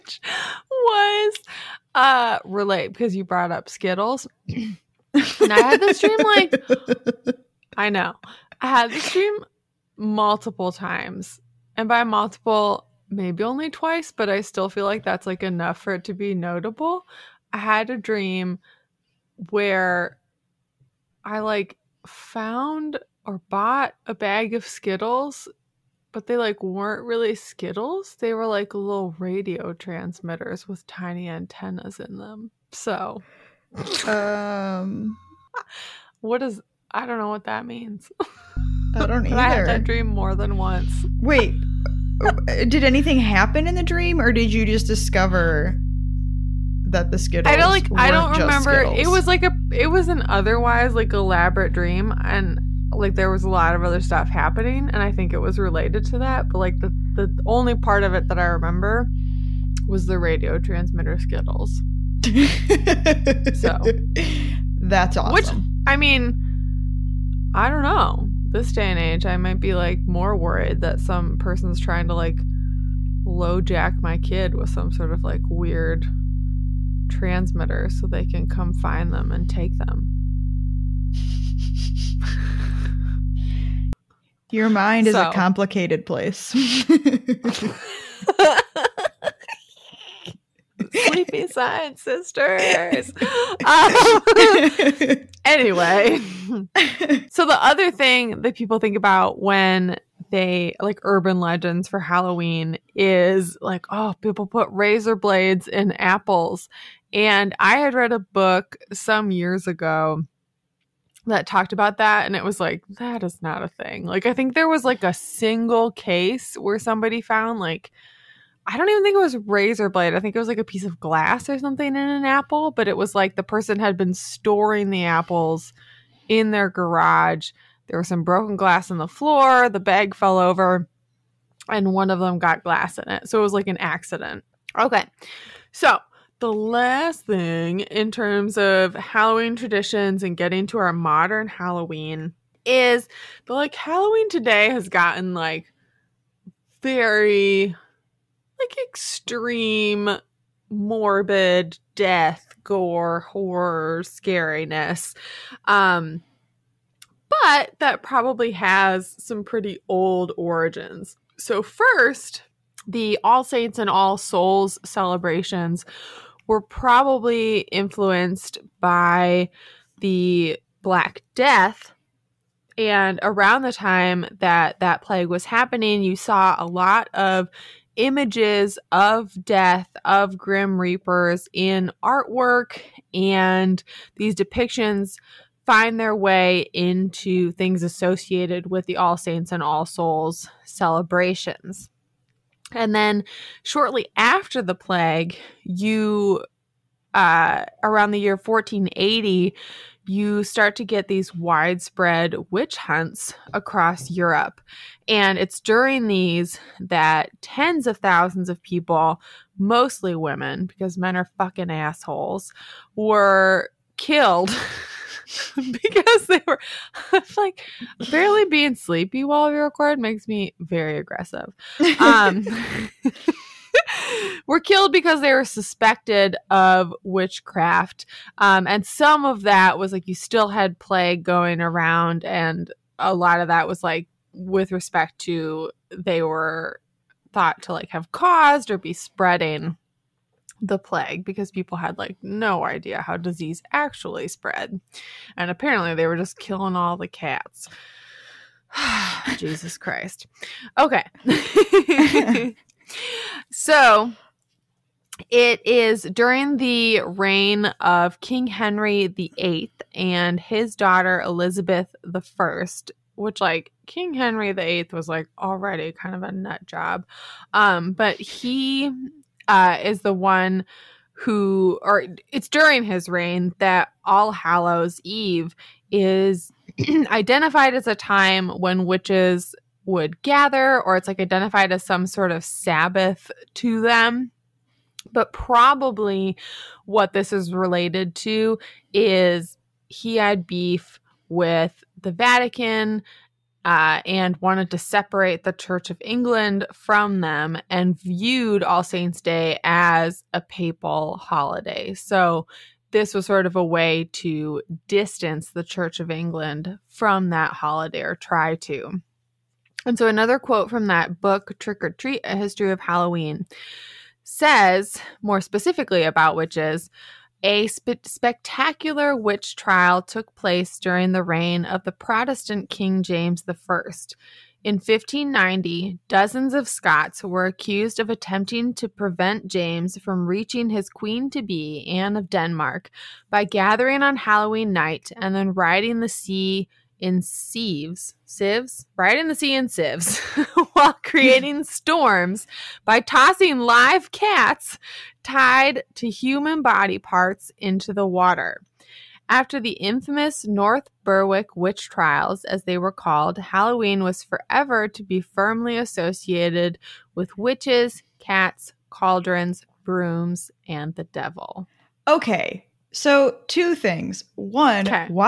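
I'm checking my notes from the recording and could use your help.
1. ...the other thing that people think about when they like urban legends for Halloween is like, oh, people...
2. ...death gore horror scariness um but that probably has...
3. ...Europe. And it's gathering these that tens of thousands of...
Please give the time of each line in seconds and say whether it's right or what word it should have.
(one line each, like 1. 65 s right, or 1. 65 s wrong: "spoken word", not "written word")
1. 97 s right
2. 151 s right
3. 204 s wrong: "during", not "gathering".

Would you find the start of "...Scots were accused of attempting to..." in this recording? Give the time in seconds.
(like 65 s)
326 s.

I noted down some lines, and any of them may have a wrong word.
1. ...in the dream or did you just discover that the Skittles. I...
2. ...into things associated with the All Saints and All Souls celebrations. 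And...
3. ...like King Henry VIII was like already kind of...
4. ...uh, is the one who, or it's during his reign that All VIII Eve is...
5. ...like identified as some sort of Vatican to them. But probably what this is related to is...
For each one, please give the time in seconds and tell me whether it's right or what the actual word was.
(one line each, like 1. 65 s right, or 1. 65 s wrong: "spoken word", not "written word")
1. 43 s right
2. 186 s right
3. 263 s right
4. 269 s wrong: "Hallows", not "VIII"
5. 281 s wrong: "Sabbath", not "Vatican".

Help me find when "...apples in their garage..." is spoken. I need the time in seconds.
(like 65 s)
125 s.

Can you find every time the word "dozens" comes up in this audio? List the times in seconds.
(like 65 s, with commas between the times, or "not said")
326 s.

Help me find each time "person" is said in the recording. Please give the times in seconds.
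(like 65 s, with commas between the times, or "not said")
71 s, 123 s.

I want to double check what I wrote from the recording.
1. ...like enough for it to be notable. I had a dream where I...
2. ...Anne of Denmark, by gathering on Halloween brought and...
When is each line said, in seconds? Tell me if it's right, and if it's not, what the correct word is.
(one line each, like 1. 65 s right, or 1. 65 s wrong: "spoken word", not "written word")
1. 15 s right
2. 331 s wrong: "night", not "brought".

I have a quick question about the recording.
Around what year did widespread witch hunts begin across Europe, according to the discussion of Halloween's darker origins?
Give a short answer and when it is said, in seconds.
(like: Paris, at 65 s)
1480, at 198 s.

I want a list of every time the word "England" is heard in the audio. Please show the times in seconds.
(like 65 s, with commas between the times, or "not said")
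295 s, 306 s.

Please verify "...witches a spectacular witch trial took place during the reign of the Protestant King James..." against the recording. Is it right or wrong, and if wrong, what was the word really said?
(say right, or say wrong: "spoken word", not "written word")
right.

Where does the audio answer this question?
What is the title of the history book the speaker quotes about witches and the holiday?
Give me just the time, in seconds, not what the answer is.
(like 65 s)
311 s.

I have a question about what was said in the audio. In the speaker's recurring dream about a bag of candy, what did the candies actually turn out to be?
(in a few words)
radio transmitters.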